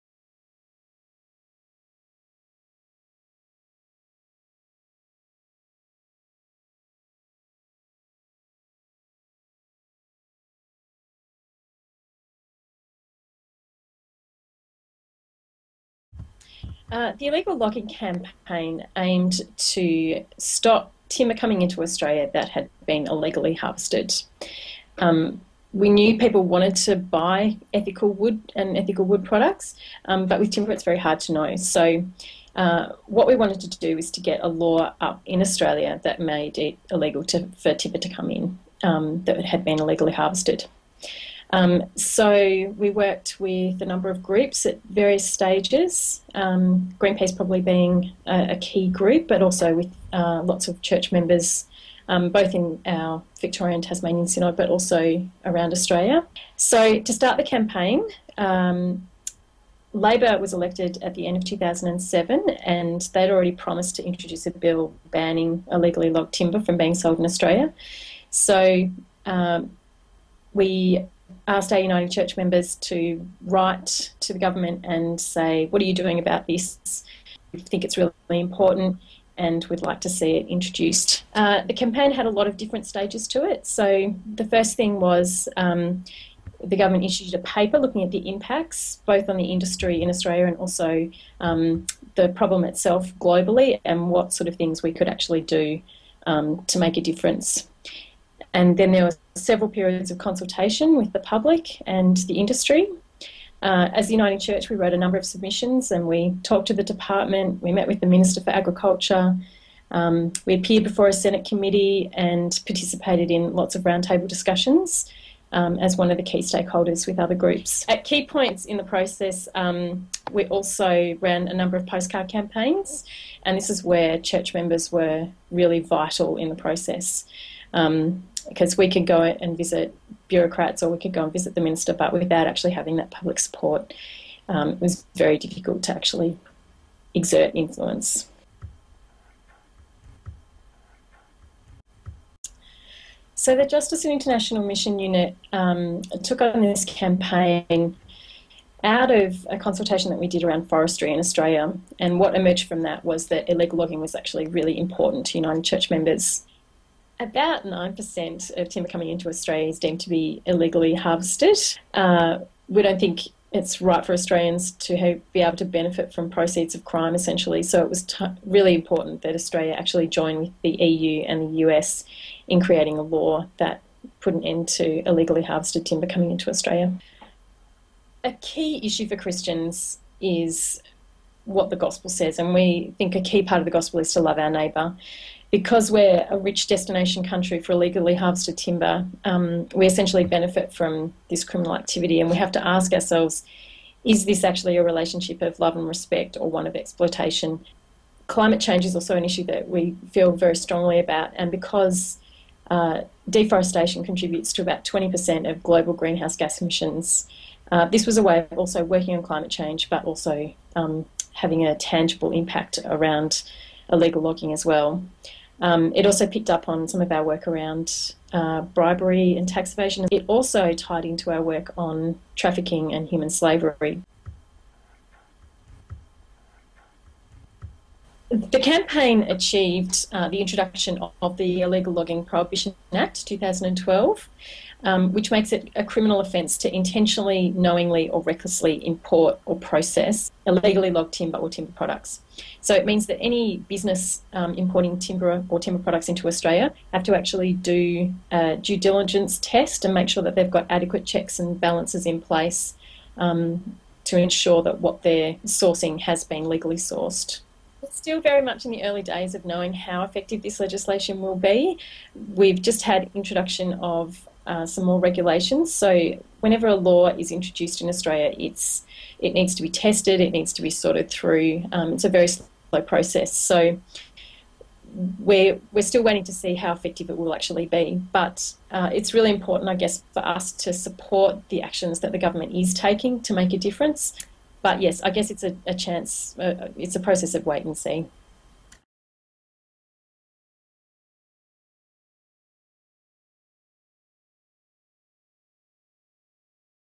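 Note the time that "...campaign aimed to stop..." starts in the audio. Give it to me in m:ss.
0:17.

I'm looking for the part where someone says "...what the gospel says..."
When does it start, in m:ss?
3:01.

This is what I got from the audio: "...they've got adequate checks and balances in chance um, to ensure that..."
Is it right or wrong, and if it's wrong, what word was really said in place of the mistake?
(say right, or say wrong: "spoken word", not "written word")
wrong: "place", not "chance".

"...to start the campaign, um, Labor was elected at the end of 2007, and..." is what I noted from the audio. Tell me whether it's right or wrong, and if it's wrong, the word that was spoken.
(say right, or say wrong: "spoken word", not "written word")
right.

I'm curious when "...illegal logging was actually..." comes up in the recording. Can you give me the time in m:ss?
2:33.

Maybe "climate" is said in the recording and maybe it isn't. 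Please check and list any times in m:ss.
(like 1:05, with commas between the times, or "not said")
3:18, 3:29.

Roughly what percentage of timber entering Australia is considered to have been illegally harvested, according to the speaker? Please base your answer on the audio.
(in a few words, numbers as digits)
9%.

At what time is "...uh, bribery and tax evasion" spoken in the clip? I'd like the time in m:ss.
3:38.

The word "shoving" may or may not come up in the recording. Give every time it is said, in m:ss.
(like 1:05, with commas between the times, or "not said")
not said.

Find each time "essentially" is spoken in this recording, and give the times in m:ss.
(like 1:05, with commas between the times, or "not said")
2:47, 3:09.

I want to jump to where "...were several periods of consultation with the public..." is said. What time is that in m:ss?
1:39.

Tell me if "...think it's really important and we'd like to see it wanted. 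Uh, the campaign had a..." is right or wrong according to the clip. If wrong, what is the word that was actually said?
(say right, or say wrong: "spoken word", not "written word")
wrong: "introduced", not "wanted".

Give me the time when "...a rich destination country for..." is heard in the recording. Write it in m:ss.
3:06.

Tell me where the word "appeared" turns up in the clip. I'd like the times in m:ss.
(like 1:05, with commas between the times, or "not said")
1:50.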